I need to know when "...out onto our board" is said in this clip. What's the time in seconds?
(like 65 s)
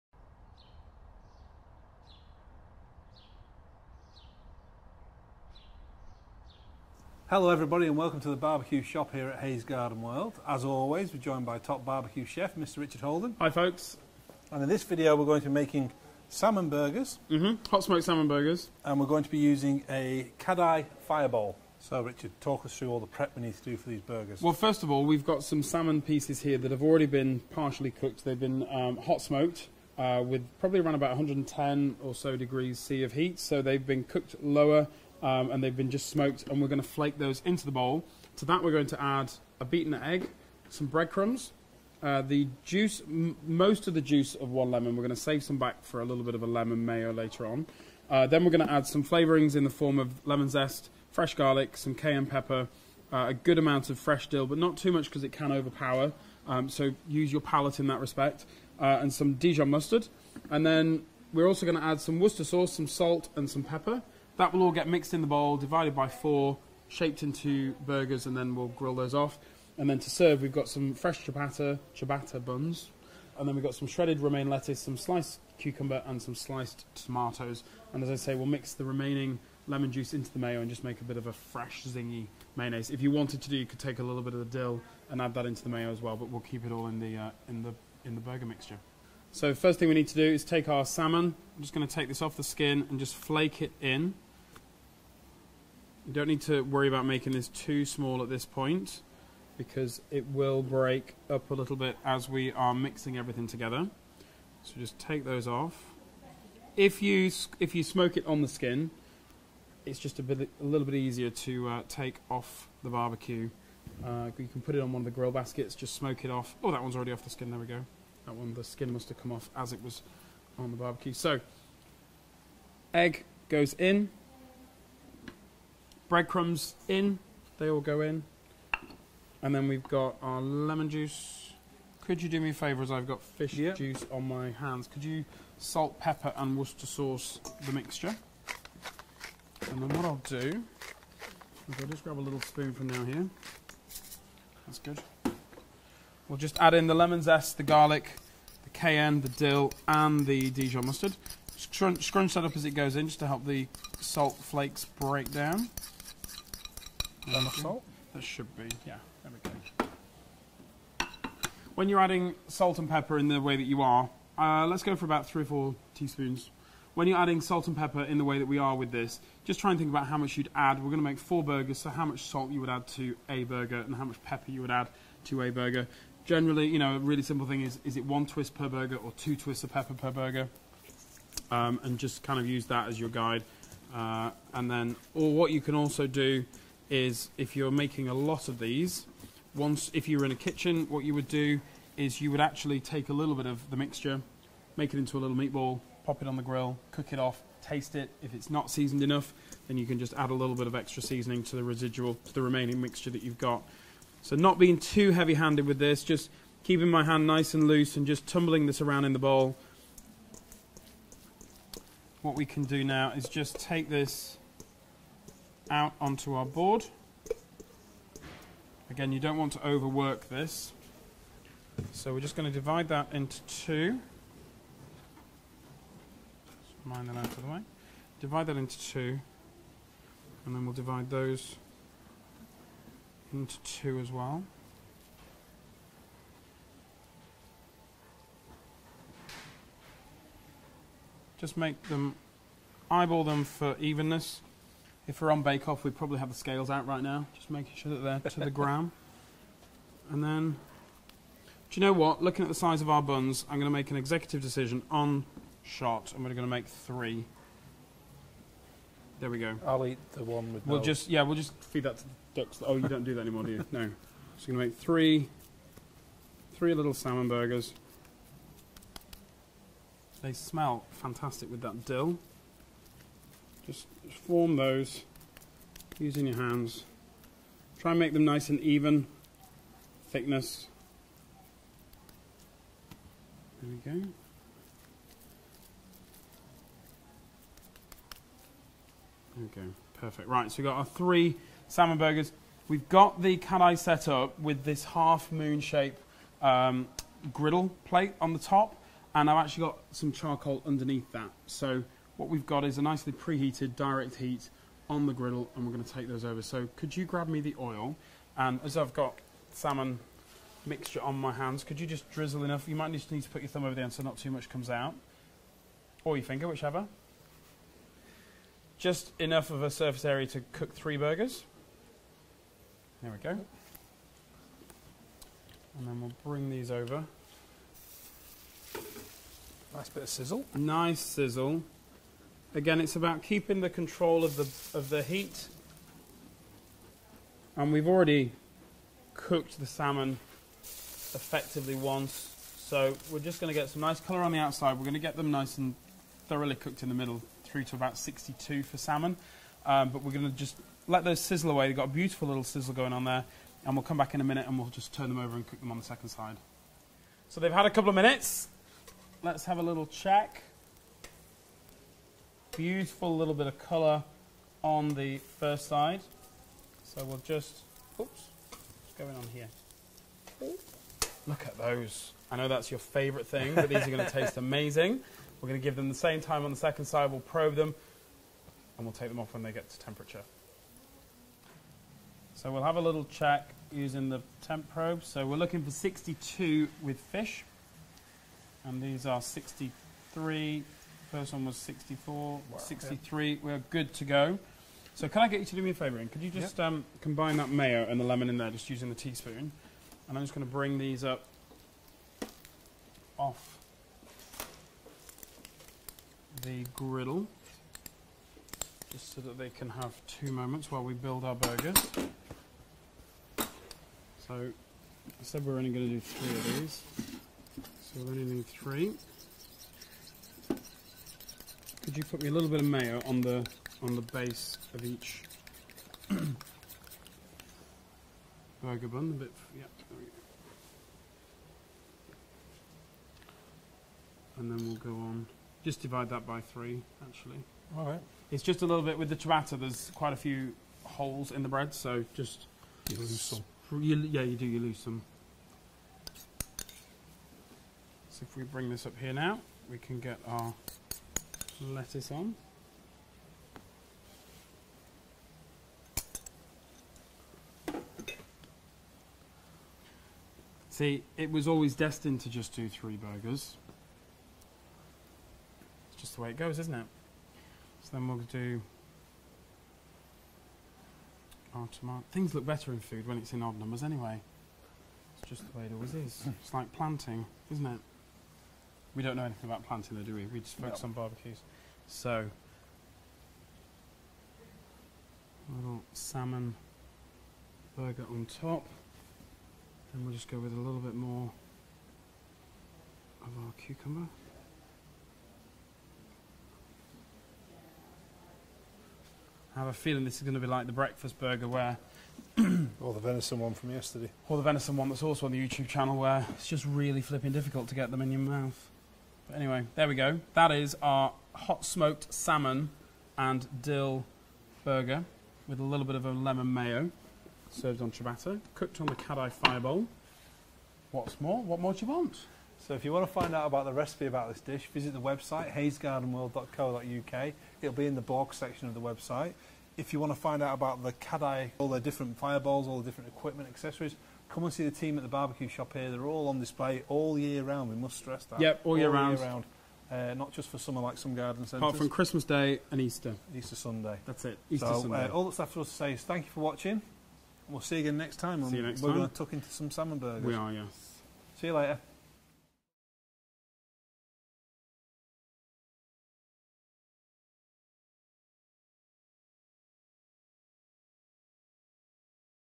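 215 s.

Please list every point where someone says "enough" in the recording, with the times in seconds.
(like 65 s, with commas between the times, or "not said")
199 s, 312 s, 319 s.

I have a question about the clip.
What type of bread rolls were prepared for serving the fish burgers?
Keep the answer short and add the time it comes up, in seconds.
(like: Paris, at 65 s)
Ciabatta buns, at 71 s.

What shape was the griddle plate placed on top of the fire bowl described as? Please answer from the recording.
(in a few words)
Half moon.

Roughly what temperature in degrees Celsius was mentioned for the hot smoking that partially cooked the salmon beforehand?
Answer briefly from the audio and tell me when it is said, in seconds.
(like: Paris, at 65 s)
110, at 31 s.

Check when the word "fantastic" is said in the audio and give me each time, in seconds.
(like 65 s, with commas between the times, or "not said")
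270 s.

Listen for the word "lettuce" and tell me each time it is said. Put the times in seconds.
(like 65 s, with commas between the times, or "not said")
74 s, 451 s.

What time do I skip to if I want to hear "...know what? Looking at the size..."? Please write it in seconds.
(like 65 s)
251 s.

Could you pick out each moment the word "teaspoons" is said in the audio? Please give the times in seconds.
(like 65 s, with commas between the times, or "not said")
165 s, 398 s.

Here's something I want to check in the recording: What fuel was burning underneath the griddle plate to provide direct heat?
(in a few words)
Charcoal.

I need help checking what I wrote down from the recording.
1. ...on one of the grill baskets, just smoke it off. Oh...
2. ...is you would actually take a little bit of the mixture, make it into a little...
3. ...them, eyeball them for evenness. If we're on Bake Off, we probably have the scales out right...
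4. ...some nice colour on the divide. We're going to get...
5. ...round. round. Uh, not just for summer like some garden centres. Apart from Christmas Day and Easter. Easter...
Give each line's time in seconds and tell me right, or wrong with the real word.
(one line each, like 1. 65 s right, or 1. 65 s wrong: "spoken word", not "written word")
1. 114 s right
2. 191 s right
3. 241 s right
4. 343 s wrong: "outside", not "divide"
5. 538 s right.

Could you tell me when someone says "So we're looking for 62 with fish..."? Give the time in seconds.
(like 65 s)
385 s.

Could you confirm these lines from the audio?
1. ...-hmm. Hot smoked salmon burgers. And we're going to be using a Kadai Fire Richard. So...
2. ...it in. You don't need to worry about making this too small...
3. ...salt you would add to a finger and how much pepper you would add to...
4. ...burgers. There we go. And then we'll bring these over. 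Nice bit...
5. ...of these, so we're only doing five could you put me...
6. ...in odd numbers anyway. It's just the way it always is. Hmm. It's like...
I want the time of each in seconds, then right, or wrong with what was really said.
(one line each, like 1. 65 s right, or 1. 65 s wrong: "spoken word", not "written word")
1. 17 s wrong: "Bowl", not "Richard"
2. 93 s right
3. 172 s wrong: "burger", not "finger"
4. 320 s right
5. 416 s wrong: "three", not "five"
6. 473 s right.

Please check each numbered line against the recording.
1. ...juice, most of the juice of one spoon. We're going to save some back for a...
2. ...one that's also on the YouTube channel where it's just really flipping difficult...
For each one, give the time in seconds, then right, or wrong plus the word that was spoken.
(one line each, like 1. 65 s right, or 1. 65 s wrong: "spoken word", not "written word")
1. 42 s wrong: "lemon", not "spoon"
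2. 504 s right.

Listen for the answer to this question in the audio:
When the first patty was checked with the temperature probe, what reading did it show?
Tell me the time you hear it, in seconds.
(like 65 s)
391 s.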